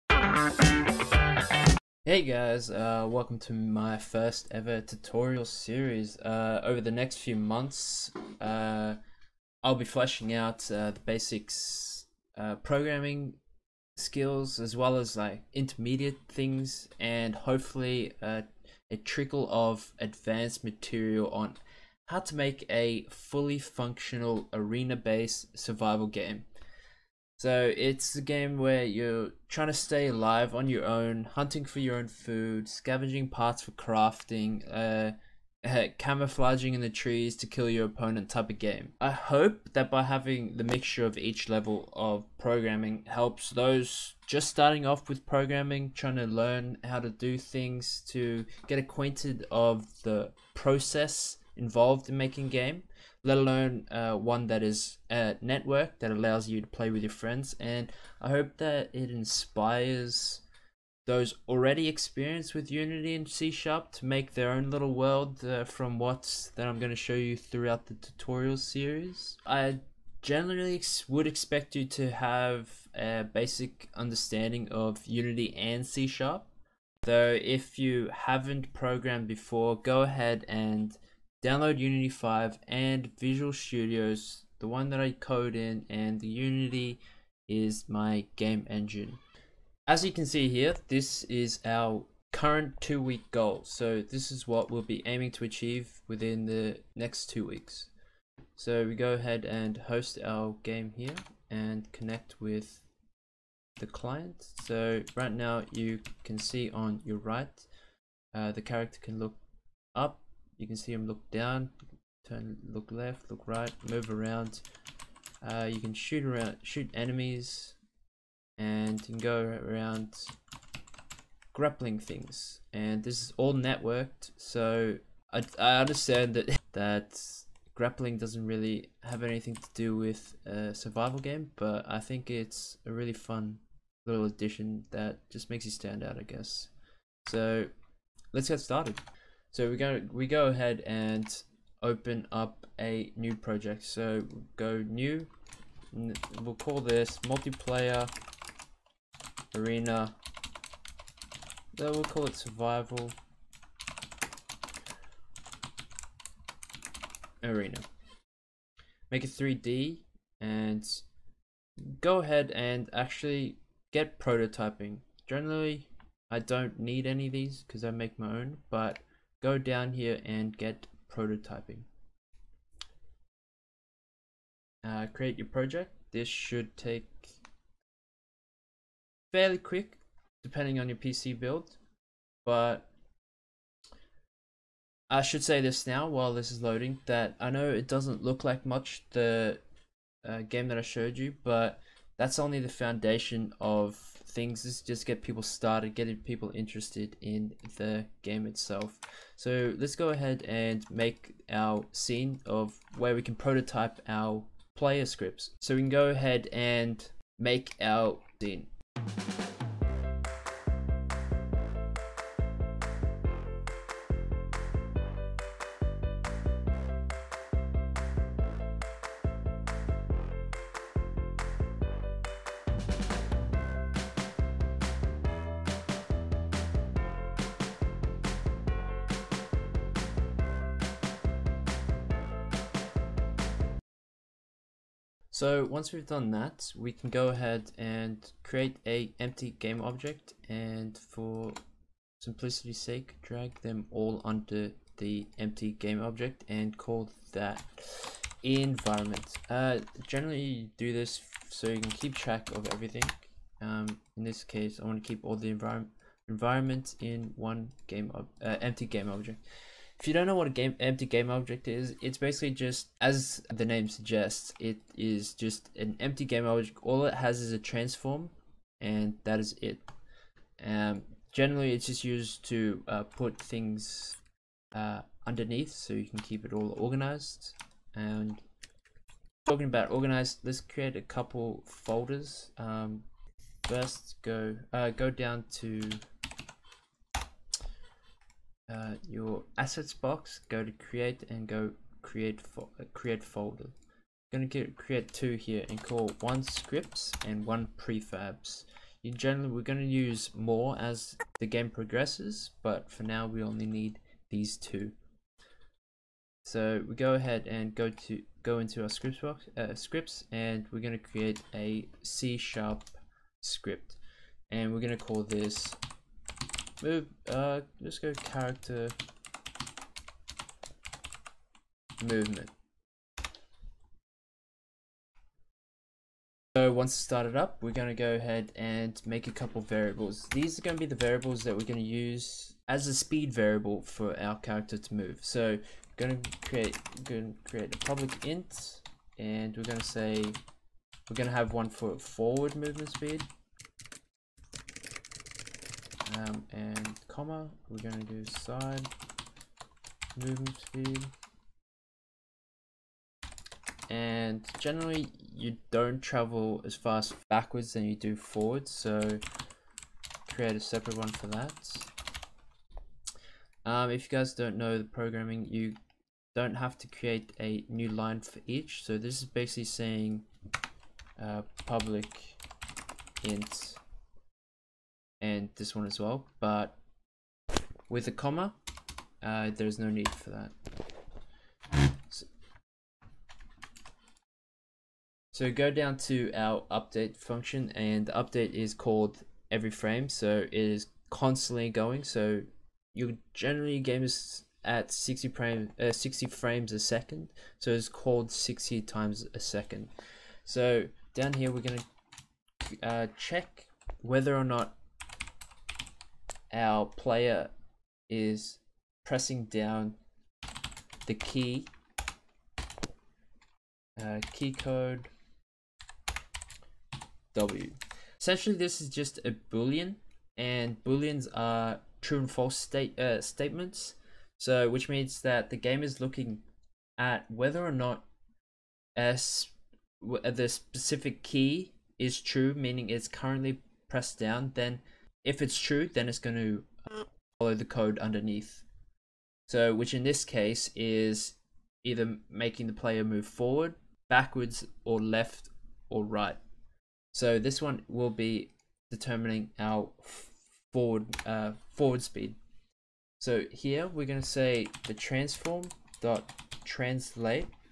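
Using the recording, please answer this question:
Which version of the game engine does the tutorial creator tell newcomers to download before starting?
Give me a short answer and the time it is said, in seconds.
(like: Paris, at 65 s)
Unity 5, at 81 s.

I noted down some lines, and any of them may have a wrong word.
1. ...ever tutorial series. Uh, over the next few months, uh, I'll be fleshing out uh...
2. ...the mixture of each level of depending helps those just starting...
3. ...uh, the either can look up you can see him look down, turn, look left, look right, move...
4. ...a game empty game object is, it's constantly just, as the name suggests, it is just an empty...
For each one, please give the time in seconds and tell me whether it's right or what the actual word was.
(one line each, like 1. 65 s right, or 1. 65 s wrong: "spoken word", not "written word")
1. 4 s right
2. 40 s wrong: "programming", not "depending"
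3. 108 s wrong: "character", not "either"
4. 260 s wrong: "basically", not "constantly".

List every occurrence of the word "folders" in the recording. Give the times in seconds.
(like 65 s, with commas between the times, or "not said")
281 s, 293 s.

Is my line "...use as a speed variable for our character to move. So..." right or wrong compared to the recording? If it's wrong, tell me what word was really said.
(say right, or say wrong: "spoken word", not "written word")
right.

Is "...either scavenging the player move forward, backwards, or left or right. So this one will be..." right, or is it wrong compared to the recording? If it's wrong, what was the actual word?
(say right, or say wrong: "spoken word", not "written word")
wrong: "making", not "scavenging".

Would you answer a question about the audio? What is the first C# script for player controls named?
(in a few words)
character movement.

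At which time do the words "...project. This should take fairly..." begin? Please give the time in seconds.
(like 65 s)
175 s.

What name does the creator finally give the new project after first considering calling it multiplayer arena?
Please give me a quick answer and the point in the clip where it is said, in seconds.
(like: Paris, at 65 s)
survival arena, at 152 s.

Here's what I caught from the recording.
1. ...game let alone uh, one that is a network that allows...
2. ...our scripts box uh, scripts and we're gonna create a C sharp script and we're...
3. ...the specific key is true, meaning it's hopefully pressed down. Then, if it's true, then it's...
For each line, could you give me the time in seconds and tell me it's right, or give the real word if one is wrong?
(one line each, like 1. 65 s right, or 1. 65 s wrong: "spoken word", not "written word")
1. 52 s right
2. 308 s right
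3. 430 s wrong: "currently", not "hopefully".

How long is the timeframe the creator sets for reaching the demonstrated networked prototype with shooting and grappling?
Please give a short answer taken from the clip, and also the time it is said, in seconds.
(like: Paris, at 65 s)
two weeks, at 92 s.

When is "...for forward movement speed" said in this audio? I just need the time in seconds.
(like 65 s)
341 s.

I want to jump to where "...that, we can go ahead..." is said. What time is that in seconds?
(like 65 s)
236 s.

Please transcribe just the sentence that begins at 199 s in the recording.
So let's go ahead and make our scene of where we can prototype our player scripts.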